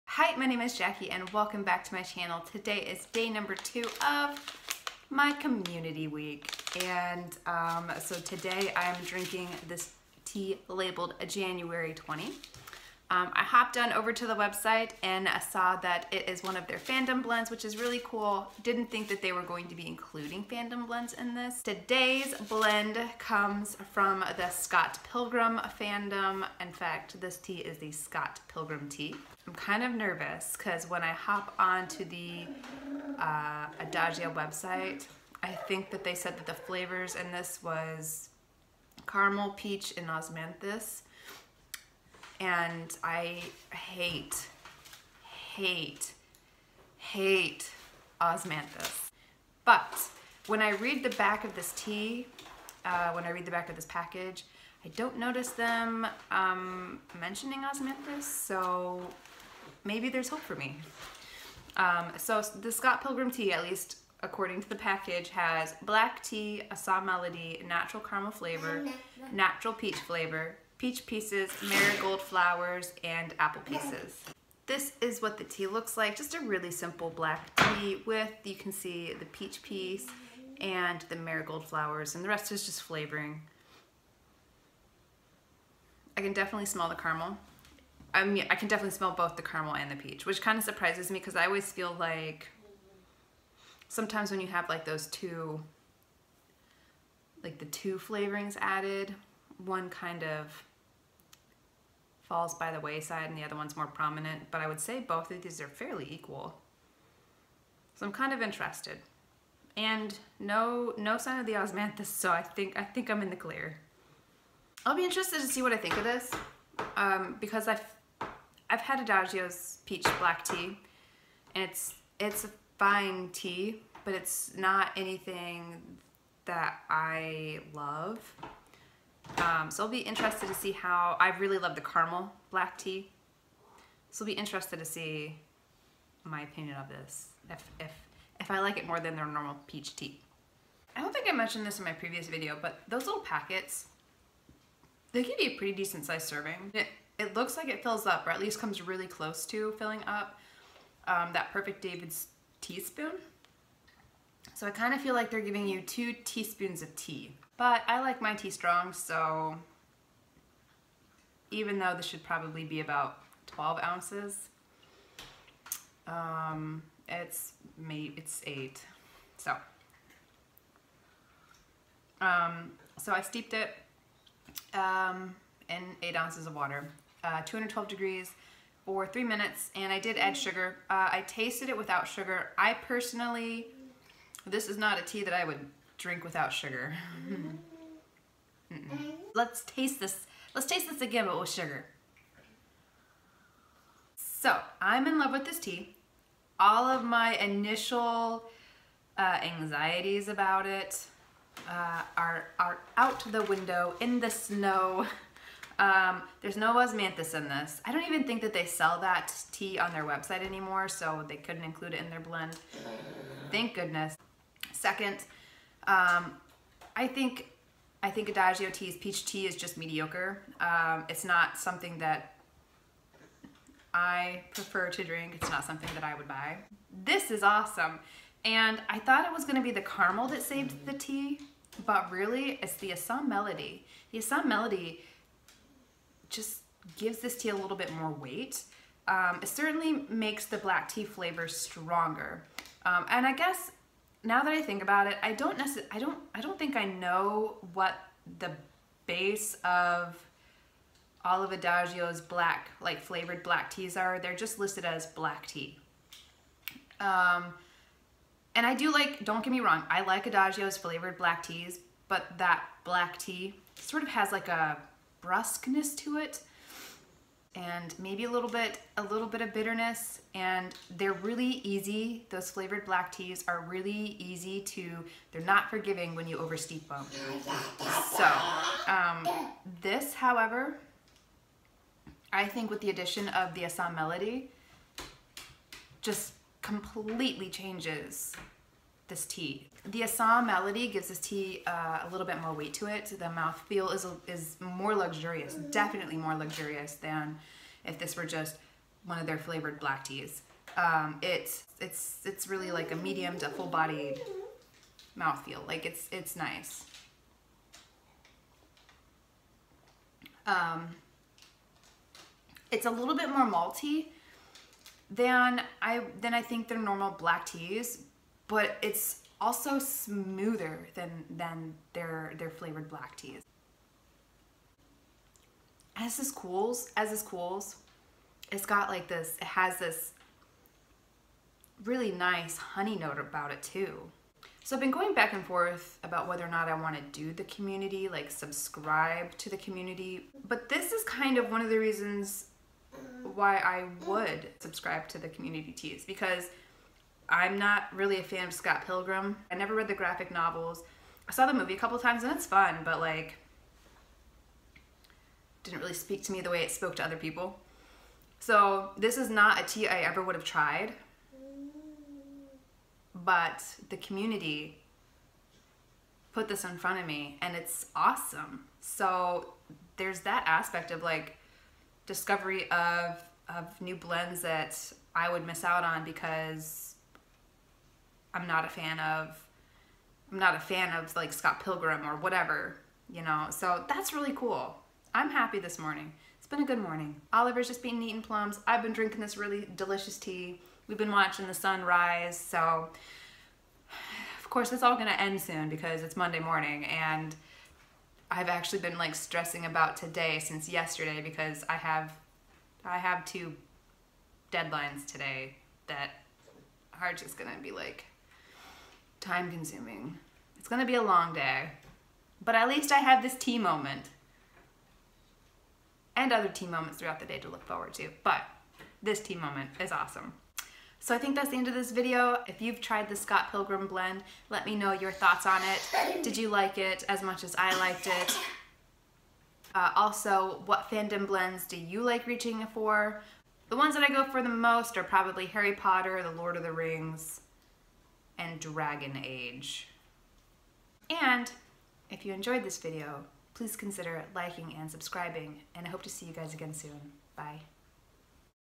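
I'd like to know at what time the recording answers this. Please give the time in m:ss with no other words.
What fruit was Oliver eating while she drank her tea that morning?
6:28.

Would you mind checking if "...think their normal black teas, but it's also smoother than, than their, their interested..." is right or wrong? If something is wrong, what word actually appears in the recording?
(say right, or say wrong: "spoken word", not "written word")
wrong: "flavored", not "interested".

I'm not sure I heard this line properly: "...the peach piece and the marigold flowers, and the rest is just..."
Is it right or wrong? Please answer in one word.
right.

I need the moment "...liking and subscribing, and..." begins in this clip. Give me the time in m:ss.
7:24.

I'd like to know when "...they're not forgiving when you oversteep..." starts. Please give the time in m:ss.
4:35.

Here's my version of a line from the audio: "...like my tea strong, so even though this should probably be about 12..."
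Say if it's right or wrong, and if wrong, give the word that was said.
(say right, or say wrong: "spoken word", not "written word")
right.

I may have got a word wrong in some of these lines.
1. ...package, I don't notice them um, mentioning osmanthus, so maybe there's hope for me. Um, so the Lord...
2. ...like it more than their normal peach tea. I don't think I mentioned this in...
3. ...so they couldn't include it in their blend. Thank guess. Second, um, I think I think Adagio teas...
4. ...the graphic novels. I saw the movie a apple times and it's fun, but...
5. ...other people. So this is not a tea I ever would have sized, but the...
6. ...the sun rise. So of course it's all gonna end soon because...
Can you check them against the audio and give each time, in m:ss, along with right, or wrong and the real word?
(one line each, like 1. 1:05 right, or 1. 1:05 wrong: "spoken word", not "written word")
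1. 0:53 wrong: "Scott", not "Lord"
2. 2:18 right
3. 3:30 wrong: "goodness", not "guess"
4. 5:49 wrong: "couple", not "apple"
5. 5:57 wrong: "tried", not "sized"
6. 6:31 right.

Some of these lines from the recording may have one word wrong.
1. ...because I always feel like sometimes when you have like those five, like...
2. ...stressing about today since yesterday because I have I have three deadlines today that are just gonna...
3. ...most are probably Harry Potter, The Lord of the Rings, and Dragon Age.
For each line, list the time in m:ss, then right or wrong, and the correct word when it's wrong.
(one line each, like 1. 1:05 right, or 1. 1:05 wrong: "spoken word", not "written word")
1. 1:31 wrong: "two", not "five"
2. 6:39 wrong: "two", not "three"
3. 7:14 right.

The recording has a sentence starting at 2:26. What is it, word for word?
It, it looks like it fills up, or at least comes really close to filling up um, that perfect David's teaspoon.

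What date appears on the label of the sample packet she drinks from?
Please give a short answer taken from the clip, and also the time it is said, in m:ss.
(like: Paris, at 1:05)
January 20, at 0:11.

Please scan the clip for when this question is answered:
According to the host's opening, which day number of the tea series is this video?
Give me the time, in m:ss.
0:03.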